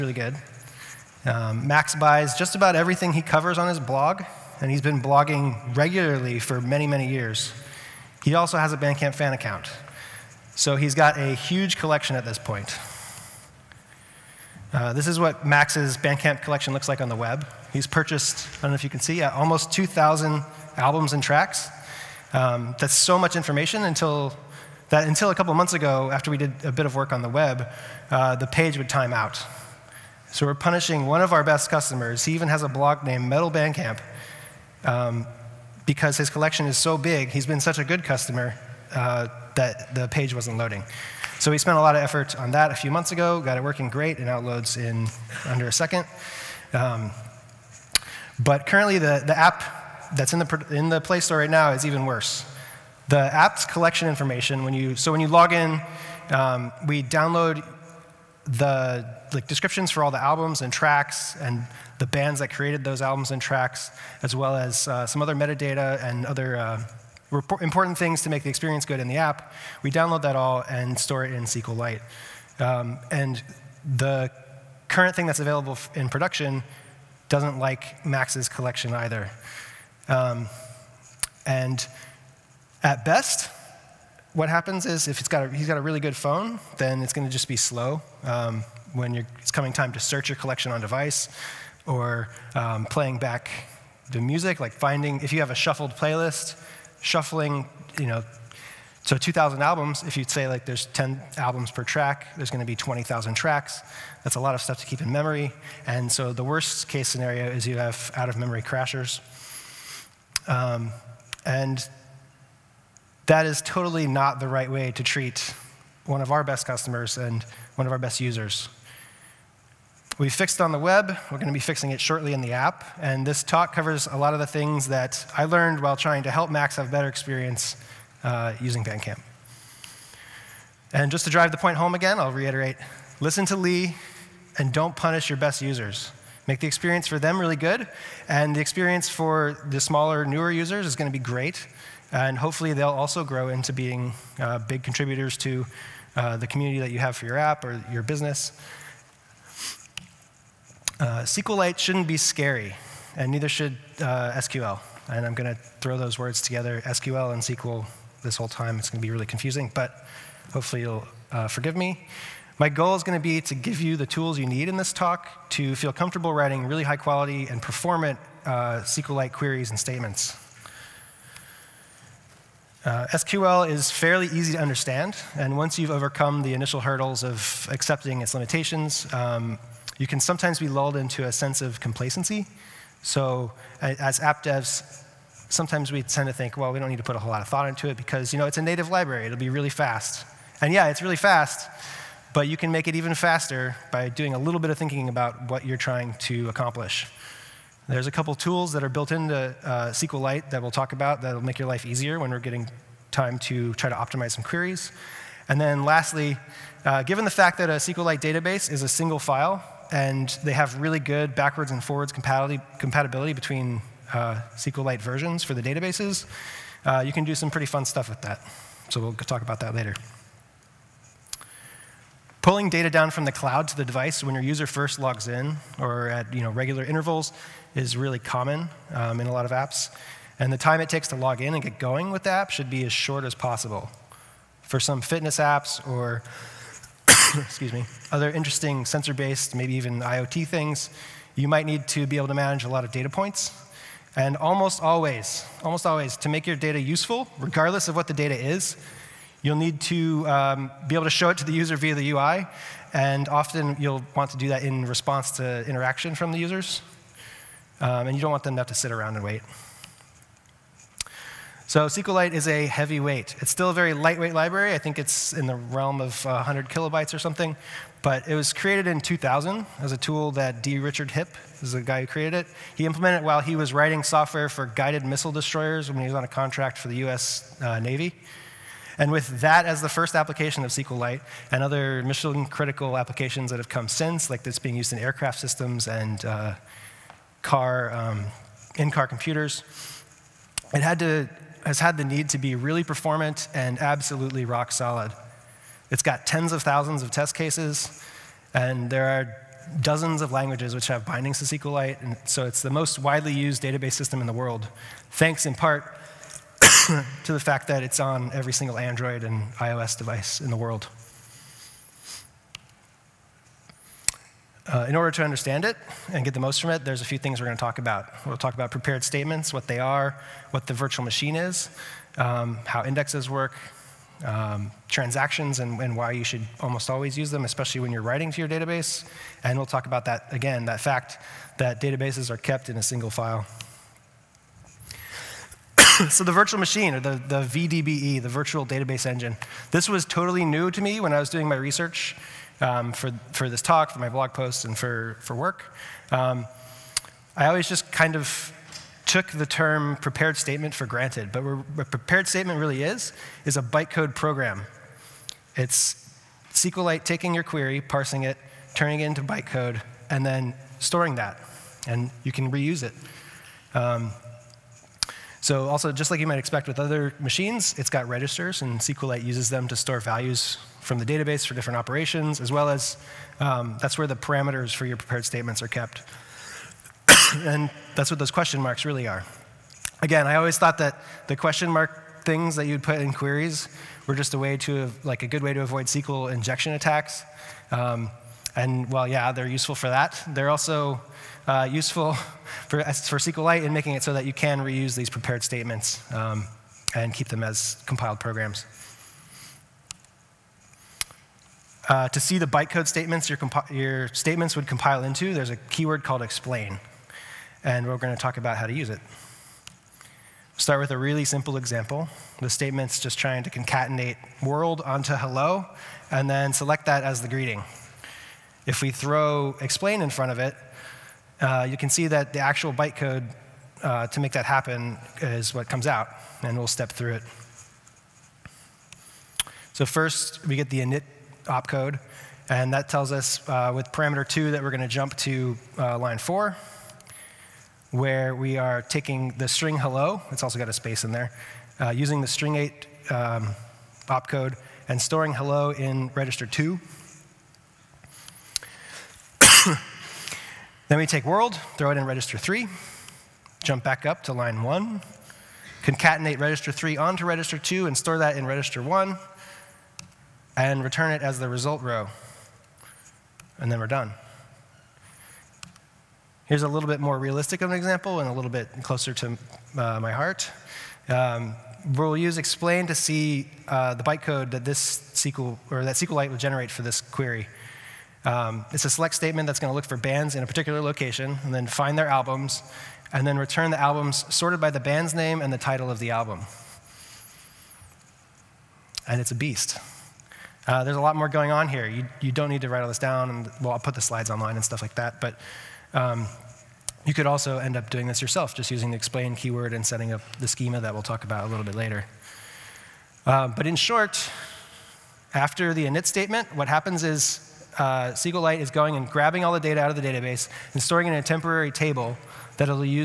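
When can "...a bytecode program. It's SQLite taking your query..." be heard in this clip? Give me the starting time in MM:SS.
05:53.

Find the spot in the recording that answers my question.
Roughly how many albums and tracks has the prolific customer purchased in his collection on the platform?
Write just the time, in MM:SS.
00:19.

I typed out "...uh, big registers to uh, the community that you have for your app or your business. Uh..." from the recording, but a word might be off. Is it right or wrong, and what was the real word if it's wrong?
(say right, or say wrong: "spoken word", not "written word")
wrong: "contributors", not "registers".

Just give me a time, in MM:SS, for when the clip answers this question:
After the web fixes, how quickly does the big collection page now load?
00:45.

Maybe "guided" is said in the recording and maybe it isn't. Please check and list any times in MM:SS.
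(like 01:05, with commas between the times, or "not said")
04:34.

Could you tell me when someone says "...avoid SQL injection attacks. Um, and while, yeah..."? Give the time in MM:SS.
06:25.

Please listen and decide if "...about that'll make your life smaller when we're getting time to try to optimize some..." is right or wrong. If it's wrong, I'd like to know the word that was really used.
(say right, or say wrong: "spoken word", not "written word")
wrong: "easier", not "smaller".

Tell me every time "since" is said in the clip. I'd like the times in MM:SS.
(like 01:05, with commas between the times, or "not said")
04:43.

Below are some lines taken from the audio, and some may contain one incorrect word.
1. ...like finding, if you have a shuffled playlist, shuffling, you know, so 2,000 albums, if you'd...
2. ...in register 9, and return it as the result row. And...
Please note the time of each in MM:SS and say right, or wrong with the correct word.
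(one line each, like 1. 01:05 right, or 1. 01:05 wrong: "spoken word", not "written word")
1. 01:34 right
2. 07:38 wrong: "1", not "9".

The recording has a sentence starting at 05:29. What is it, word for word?
And we'll talk about that again, that fact that databases are kept in a single file.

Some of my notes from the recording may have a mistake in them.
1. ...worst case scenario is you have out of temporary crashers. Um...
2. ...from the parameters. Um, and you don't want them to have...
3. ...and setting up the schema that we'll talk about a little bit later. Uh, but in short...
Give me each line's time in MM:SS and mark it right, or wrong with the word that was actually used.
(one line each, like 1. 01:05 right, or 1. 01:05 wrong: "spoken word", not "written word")
1. 01:46 wrong: "memory", not "temporary"
2. 04:16 wrong: "users", not "parameters"
3. 08:19 right.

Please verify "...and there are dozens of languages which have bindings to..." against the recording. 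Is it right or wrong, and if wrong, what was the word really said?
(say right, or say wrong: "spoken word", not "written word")
right.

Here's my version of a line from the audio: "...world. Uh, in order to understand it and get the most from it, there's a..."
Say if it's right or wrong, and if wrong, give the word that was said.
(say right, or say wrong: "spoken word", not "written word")
right.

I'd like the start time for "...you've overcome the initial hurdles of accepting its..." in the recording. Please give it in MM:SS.
02:55.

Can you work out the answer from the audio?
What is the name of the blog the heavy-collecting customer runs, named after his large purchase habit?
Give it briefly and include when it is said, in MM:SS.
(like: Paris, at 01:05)
Metal Bandcamp, at 00:33.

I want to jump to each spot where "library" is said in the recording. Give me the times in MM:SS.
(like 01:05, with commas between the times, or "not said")
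03:08, 04:24.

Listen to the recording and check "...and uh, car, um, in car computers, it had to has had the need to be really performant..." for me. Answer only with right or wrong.
right.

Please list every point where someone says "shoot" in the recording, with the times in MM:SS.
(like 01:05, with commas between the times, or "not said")
not said.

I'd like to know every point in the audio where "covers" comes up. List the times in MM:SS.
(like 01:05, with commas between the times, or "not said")
00:03, 02:03.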